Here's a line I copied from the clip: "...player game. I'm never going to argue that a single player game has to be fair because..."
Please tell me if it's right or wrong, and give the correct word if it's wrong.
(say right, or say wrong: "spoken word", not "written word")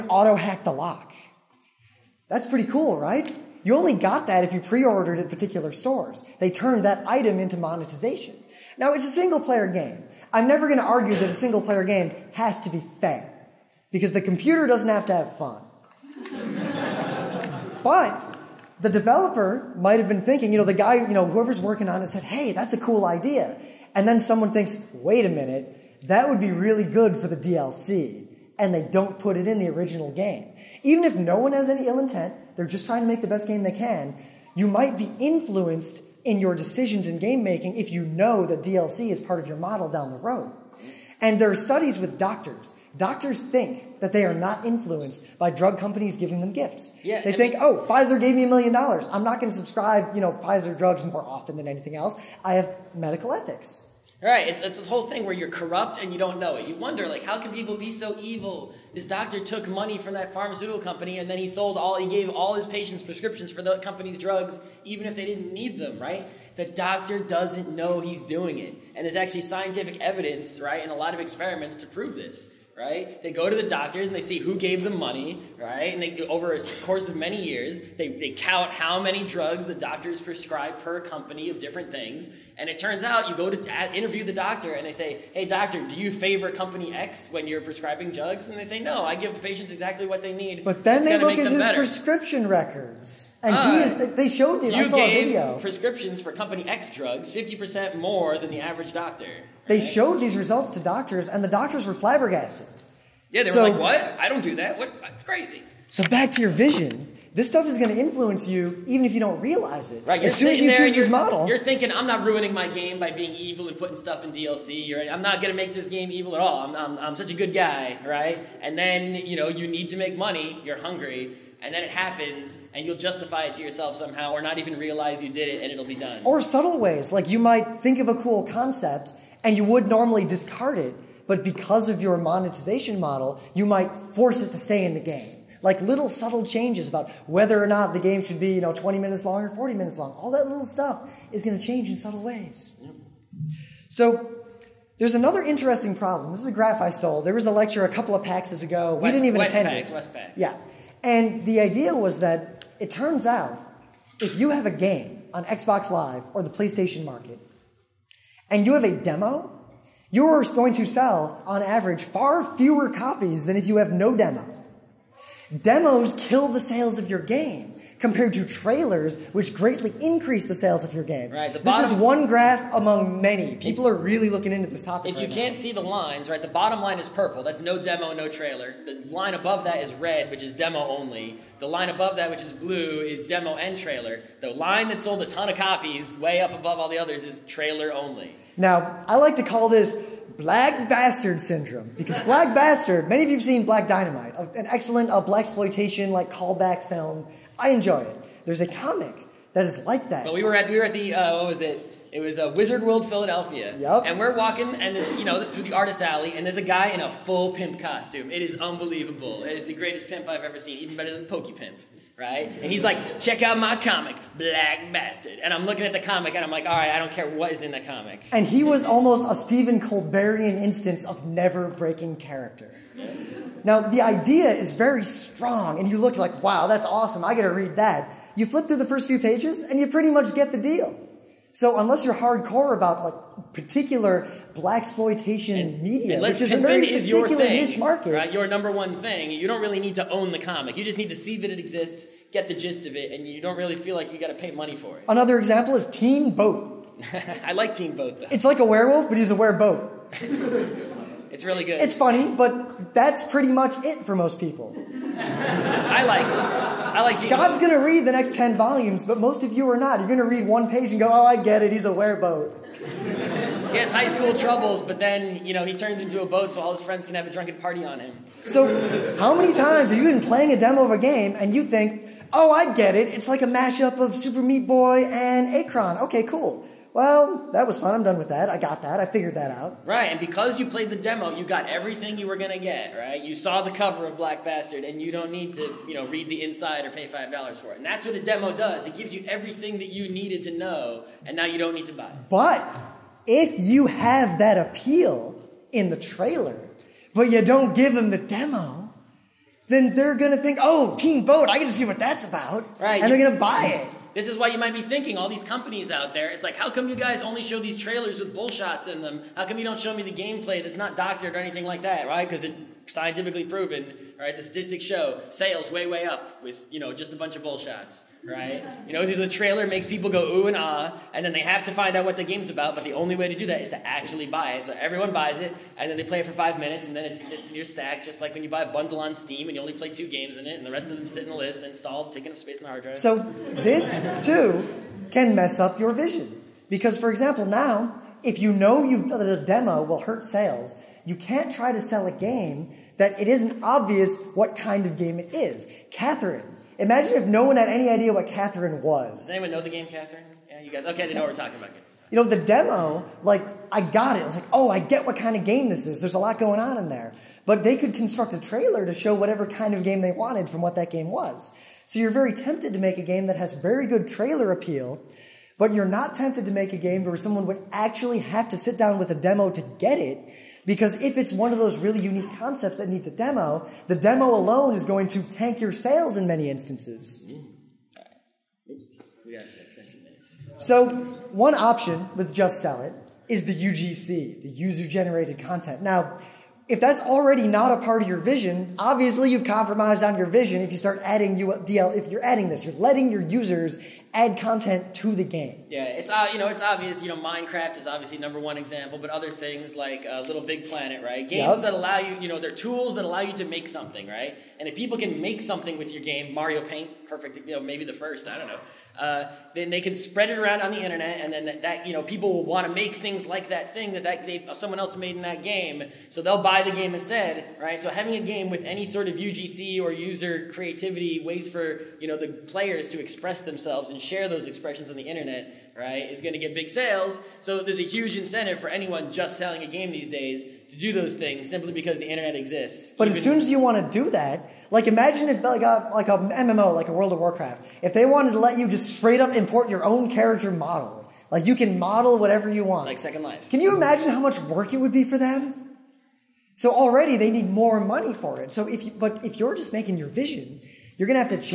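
right.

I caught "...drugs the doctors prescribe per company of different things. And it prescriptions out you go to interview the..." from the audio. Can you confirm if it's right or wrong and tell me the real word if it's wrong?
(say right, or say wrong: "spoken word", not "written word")
wrong: "turns", not "prescriptions".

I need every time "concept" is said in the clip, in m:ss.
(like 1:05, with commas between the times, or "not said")
2:08, 6:12.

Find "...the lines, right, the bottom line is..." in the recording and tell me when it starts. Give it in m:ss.
2:55.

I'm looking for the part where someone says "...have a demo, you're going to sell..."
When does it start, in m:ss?
2:38.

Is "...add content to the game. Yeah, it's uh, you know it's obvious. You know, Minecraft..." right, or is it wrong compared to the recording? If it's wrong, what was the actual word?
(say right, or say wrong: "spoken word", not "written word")
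right.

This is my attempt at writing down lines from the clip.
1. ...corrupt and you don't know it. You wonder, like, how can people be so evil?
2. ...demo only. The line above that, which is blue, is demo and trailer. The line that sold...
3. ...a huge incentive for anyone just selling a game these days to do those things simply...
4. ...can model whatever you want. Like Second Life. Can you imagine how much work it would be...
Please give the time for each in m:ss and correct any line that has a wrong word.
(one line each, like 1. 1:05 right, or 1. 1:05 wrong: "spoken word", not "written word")
1. 0:55 right
2. 3:00 right
3. 7:07 right
4. 7:21 right.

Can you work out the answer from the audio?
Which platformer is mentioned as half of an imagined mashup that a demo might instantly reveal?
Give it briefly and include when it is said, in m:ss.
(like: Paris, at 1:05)
Super Meat Boy, at 4:34.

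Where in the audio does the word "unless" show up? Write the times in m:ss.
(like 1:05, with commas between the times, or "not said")
3:51, 3:56.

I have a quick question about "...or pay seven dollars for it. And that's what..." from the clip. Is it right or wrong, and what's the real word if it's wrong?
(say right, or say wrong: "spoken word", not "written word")
wrong: "five", not "seven".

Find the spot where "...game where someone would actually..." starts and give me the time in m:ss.
6:06.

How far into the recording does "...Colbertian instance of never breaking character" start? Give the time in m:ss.
3:39.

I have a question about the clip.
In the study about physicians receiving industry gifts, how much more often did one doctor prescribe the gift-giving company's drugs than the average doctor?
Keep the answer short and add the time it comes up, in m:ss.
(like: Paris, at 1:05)
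50%, at 1:37.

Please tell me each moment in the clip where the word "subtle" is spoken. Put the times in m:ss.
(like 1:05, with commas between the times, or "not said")
2:06, 2:16, 2:21.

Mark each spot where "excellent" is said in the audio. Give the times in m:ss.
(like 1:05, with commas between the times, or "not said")
3:14.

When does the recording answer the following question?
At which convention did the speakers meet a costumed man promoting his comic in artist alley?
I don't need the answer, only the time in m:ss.
3:22.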